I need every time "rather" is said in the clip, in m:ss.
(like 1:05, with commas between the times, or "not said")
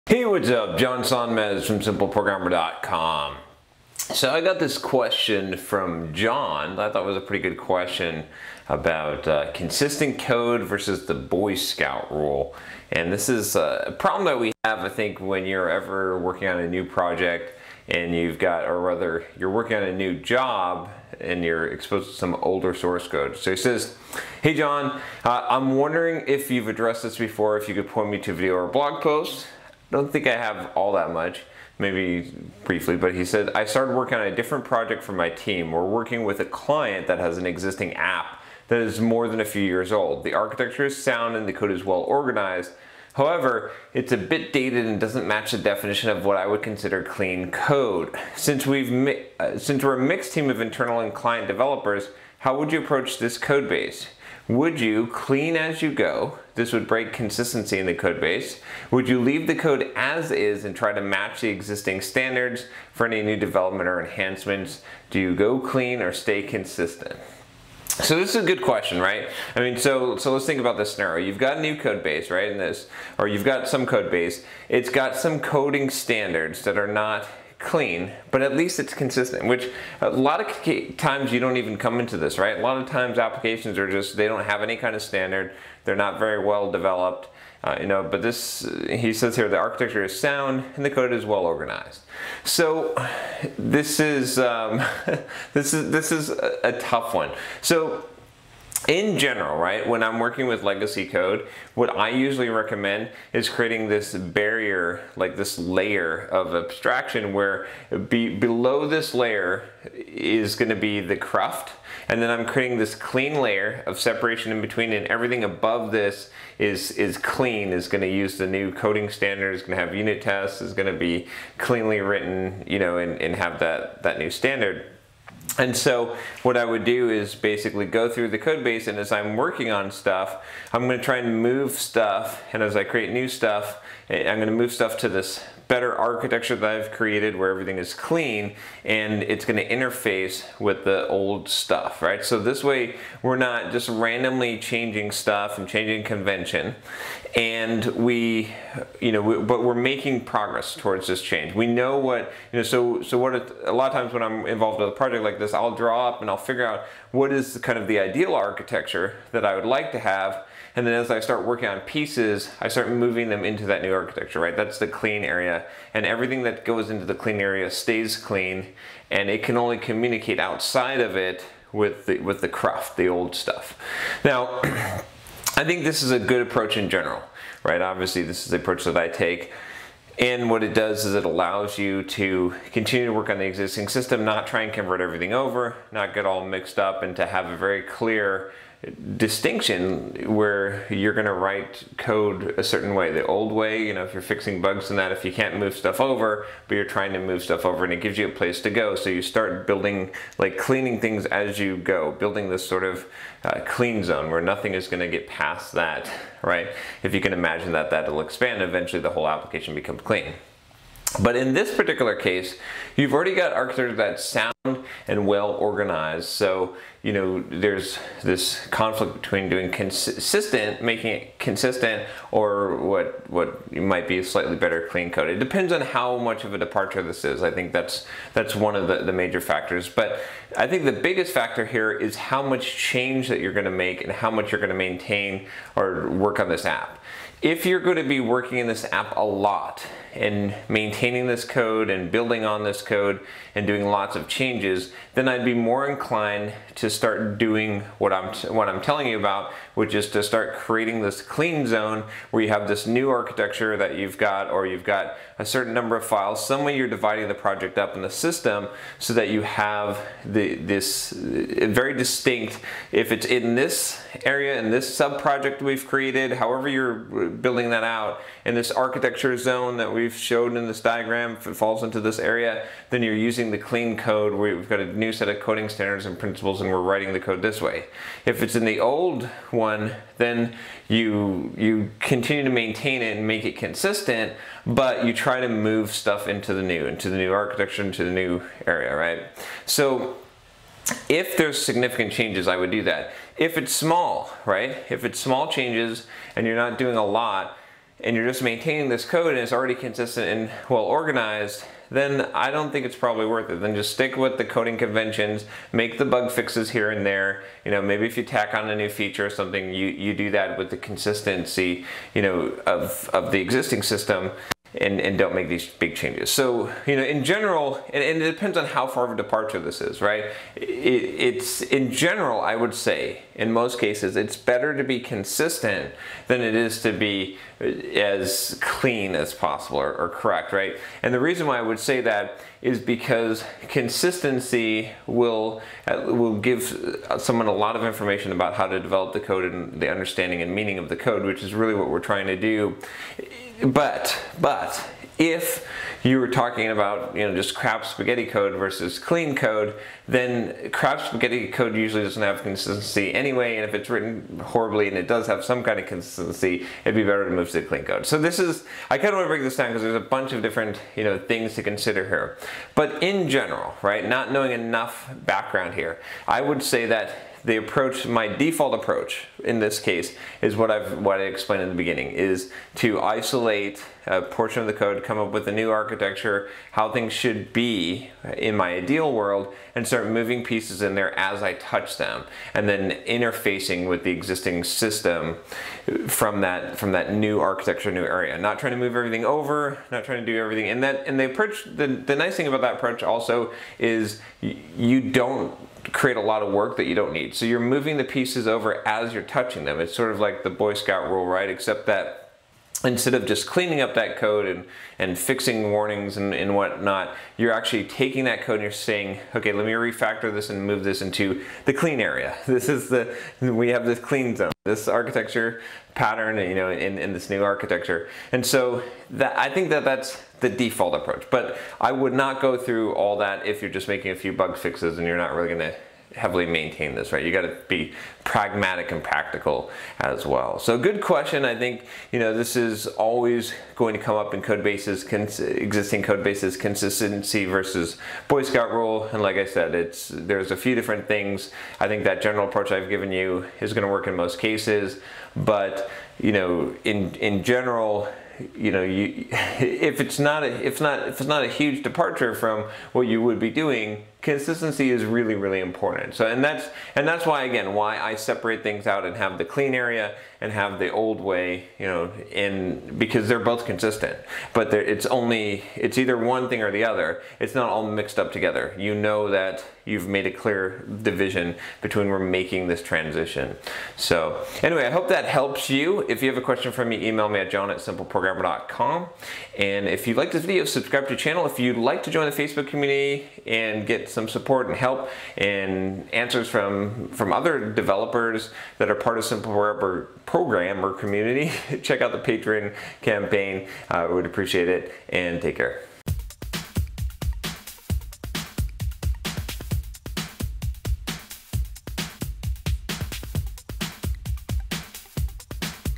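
0:18.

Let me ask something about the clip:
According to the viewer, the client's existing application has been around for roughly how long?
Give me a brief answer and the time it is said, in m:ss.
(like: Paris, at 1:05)
more than a few years, at 0:39.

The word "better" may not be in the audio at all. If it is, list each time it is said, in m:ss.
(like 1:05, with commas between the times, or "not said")
2:15, 3:44, 5:24, 5:57.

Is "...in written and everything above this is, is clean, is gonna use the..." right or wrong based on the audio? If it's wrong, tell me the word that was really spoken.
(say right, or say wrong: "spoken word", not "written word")
wrong: "between", not "written".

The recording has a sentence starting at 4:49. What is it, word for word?
So if there's significant changes, I would do that if it's small, right?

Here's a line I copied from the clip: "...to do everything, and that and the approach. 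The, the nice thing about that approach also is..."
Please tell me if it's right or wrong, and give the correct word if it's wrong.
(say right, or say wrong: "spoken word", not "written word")
right.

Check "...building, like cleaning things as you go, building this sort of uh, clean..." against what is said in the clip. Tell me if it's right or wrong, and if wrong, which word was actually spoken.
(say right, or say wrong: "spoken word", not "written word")
right.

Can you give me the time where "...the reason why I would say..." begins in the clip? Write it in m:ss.
5:31.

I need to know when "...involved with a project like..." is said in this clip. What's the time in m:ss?
2:34.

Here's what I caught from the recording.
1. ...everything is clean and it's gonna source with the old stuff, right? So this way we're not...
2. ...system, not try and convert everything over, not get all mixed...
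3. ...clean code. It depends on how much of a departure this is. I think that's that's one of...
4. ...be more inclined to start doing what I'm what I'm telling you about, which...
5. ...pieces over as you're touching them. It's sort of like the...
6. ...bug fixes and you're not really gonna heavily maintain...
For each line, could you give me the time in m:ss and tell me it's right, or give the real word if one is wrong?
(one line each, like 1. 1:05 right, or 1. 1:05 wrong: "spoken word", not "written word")
1. 2:17 wrong: "interface", not "source"
2. 3:03 right
3. 3:44 right
4. 4:05 right
5. 6:38 right
6. 7:04 right.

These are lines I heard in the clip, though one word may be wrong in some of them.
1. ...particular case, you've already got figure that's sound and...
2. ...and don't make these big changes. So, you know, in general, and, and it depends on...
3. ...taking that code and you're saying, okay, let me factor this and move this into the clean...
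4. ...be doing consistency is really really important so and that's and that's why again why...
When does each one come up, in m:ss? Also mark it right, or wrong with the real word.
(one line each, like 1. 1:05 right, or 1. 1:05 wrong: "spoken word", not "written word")
1. 3:31 wrong: "architecture", not "figure"
2. 5:15 right
3. 6:47 wrong: "refactor", not "factor"
4. 7:33 right.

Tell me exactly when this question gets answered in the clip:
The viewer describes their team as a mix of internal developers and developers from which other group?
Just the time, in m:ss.
0:51.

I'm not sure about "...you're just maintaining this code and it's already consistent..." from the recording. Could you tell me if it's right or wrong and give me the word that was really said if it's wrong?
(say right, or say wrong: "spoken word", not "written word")
right.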